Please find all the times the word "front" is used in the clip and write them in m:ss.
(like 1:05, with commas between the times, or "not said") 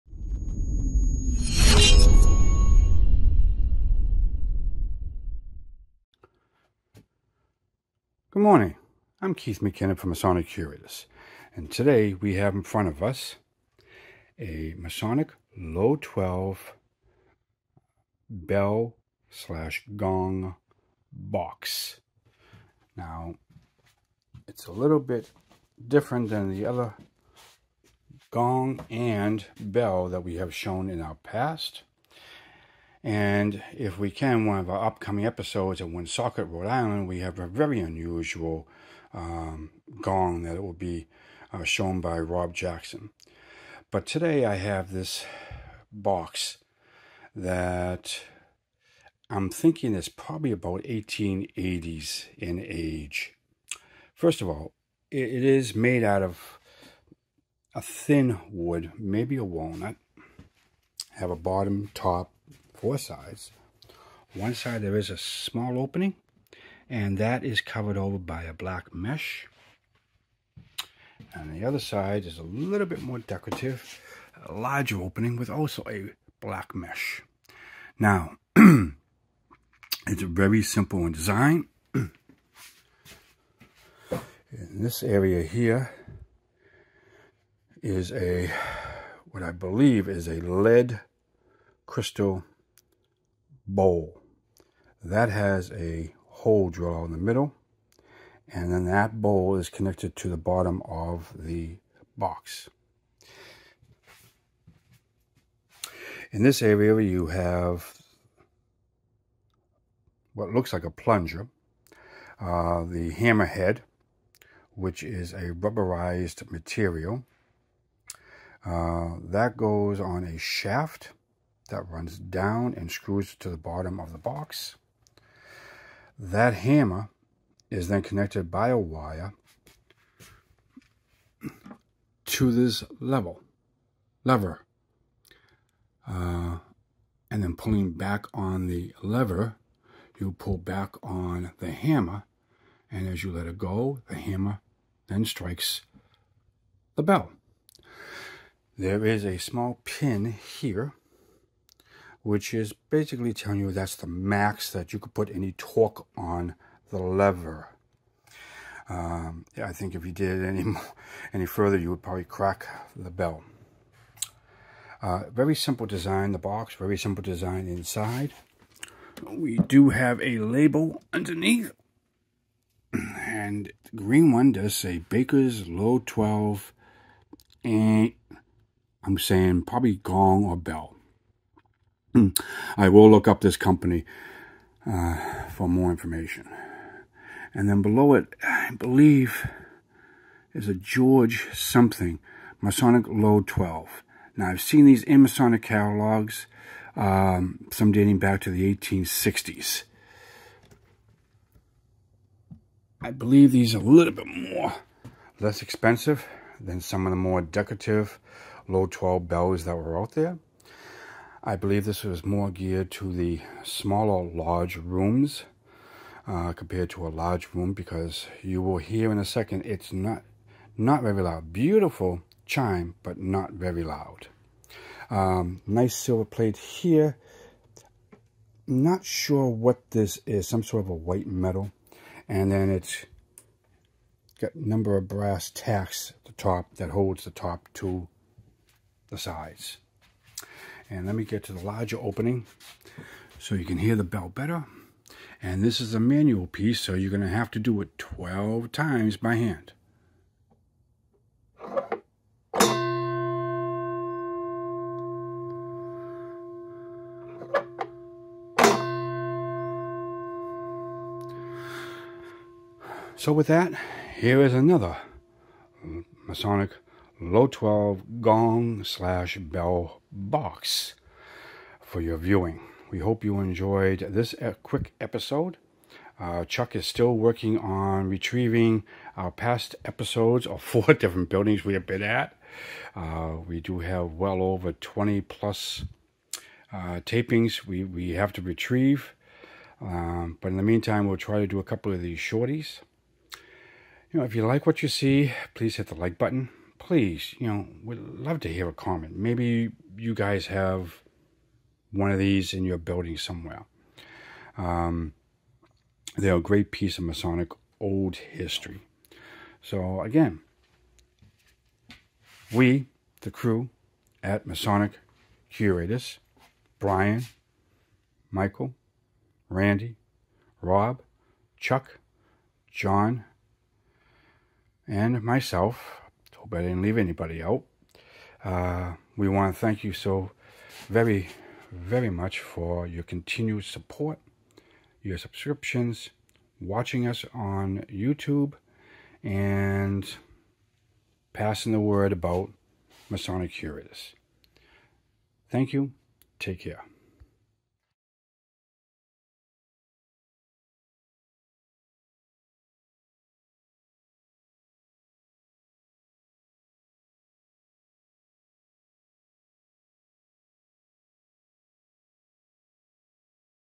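0:12.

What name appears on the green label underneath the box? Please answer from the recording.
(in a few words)
Baker's Low 12.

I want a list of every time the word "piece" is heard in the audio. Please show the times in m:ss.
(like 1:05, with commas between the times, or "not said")
4:06, 5:06.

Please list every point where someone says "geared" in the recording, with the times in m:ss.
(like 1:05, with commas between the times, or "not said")
3:32.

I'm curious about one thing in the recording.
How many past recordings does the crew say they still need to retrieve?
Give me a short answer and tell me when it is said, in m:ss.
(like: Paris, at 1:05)
over 20, at 4:44.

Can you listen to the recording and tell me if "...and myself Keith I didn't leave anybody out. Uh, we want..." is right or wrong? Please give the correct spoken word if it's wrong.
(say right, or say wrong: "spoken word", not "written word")
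wrong: "Hope", not "Keith".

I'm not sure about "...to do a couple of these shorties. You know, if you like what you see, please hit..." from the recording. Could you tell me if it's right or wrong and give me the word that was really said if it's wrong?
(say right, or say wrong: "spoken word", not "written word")
right.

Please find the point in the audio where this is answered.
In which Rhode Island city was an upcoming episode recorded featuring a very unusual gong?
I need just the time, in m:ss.
0:35.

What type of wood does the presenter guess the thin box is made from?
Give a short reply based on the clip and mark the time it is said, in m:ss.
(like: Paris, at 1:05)
walnut, at 0:59.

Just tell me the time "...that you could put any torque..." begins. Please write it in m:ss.
2:34.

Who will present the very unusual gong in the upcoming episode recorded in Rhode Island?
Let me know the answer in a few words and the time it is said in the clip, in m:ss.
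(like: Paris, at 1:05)
Rob Jackson, at 0:42.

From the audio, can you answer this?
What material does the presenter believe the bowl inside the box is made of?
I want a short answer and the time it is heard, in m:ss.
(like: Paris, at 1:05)
lead crystal, at 1:30.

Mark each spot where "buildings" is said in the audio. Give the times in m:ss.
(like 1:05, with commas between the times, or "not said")
4:41, 5:02.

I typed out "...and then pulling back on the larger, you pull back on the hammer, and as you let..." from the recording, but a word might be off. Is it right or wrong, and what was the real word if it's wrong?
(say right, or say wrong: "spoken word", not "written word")
wrong: "lever", not "larger".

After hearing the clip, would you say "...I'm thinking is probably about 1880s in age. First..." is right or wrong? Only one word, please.
right.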